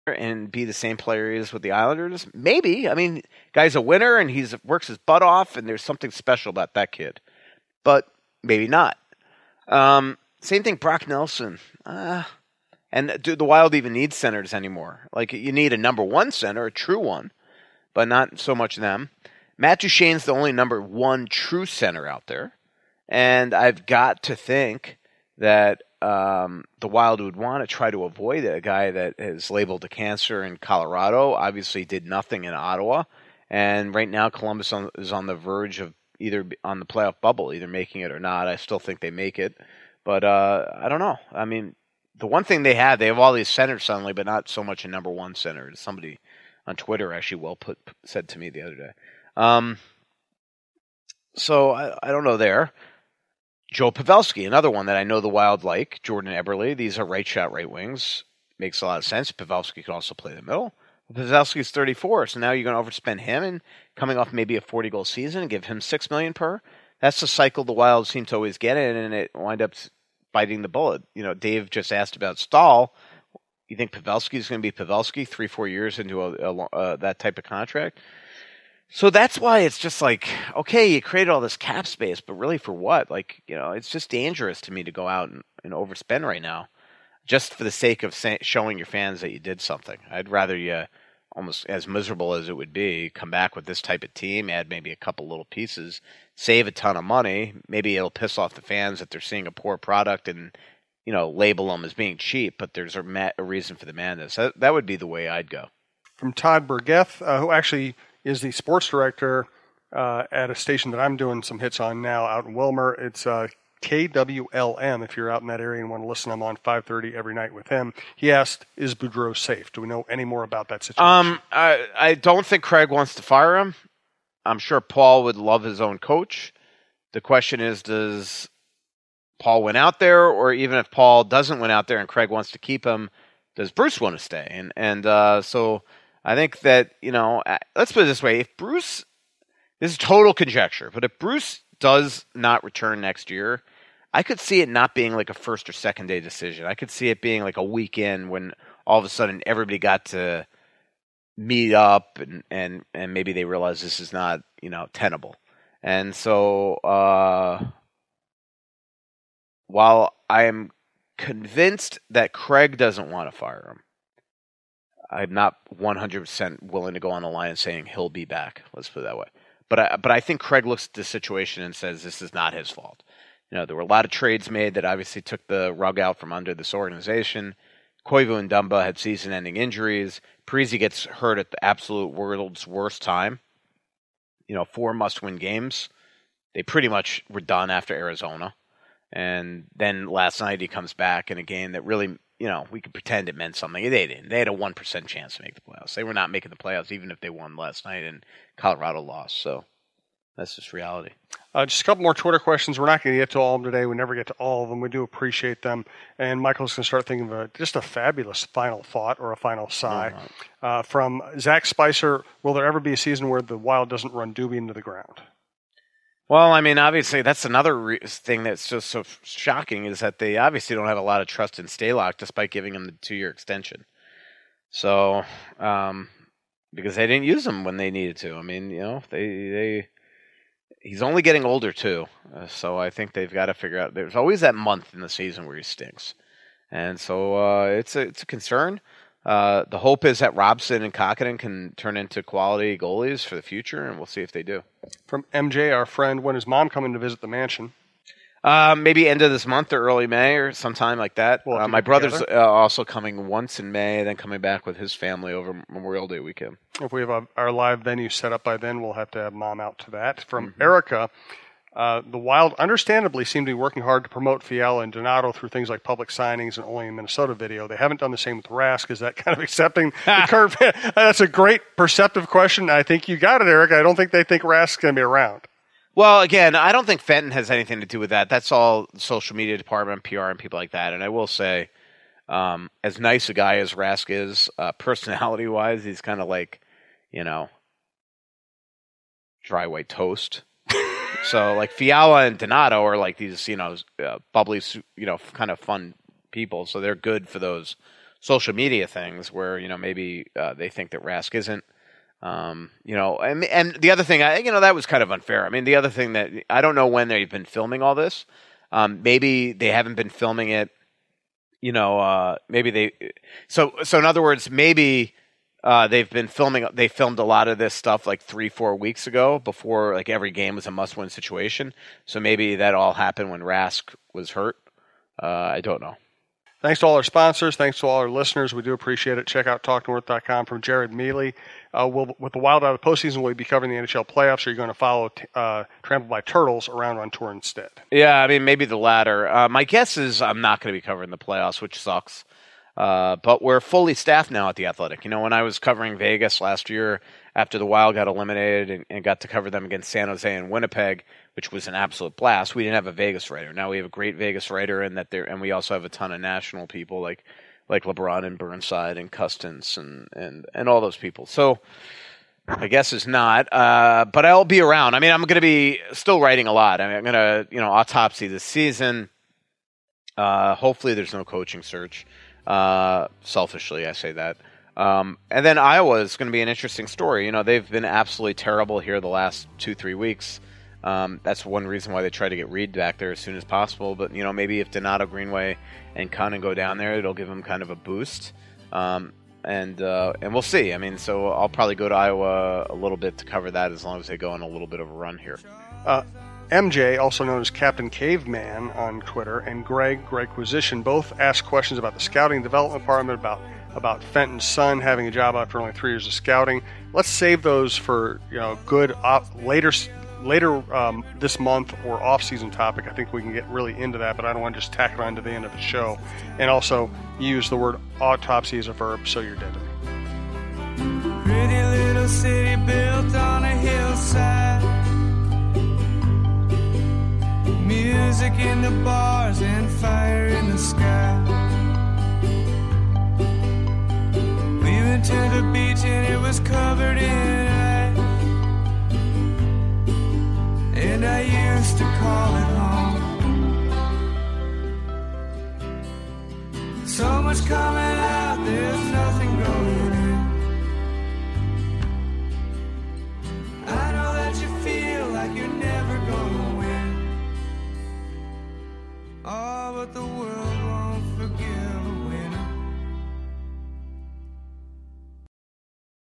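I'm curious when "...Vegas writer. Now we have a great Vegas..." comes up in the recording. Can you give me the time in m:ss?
5:52.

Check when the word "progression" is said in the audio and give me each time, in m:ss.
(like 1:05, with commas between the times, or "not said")
not said.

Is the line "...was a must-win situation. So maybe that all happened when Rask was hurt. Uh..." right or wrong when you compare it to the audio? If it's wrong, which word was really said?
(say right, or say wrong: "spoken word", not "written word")
right.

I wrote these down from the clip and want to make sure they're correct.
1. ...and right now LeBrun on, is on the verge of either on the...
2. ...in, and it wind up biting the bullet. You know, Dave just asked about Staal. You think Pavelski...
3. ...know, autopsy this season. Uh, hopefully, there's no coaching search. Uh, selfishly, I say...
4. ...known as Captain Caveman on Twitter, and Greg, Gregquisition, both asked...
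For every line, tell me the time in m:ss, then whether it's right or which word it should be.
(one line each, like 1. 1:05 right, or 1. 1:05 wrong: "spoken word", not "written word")
1. 0:33 wrong: "Columbus", not "LeBrun"
2. 1:08 right
3. 6:07 right
4. 6:37 right.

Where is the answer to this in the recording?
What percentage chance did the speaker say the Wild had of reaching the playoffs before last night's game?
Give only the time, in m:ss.
3:14.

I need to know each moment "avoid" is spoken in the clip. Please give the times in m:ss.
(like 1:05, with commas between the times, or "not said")
0:28.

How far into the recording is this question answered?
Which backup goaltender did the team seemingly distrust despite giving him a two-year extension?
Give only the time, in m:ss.
3:41.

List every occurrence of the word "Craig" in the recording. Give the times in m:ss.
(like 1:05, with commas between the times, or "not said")
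2:02, 2:12, 2:42, 2:50.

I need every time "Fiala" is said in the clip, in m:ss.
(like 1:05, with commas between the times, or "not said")
4:24, 4:51.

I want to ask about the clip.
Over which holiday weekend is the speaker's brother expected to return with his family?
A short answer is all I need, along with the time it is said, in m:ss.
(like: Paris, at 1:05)
Memorial Day, at 4:15.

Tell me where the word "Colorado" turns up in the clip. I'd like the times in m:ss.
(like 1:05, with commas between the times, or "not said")
0:30, 3:18.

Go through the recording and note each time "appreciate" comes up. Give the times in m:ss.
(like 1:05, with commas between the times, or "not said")
3:25, 5:28.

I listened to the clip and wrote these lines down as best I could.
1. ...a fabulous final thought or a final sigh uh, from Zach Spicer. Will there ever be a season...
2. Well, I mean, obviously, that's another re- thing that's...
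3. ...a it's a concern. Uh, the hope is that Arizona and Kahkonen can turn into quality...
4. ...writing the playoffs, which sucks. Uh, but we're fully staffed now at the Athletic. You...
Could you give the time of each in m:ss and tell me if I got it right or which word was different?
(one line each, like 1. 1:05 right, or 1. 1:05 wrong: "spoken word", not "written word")
1. 3:27 right
2. 3:36 right
3. 3:57 wrong: "Robson", not "Arizona"
4. 5:40 wrong: "covering", not "writing".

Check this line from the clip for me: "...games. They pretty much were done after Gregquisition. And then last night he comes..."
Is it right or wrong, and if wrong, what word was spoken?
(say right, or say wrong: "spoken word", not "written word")
wrong: "Arizona", not "Gregquisition".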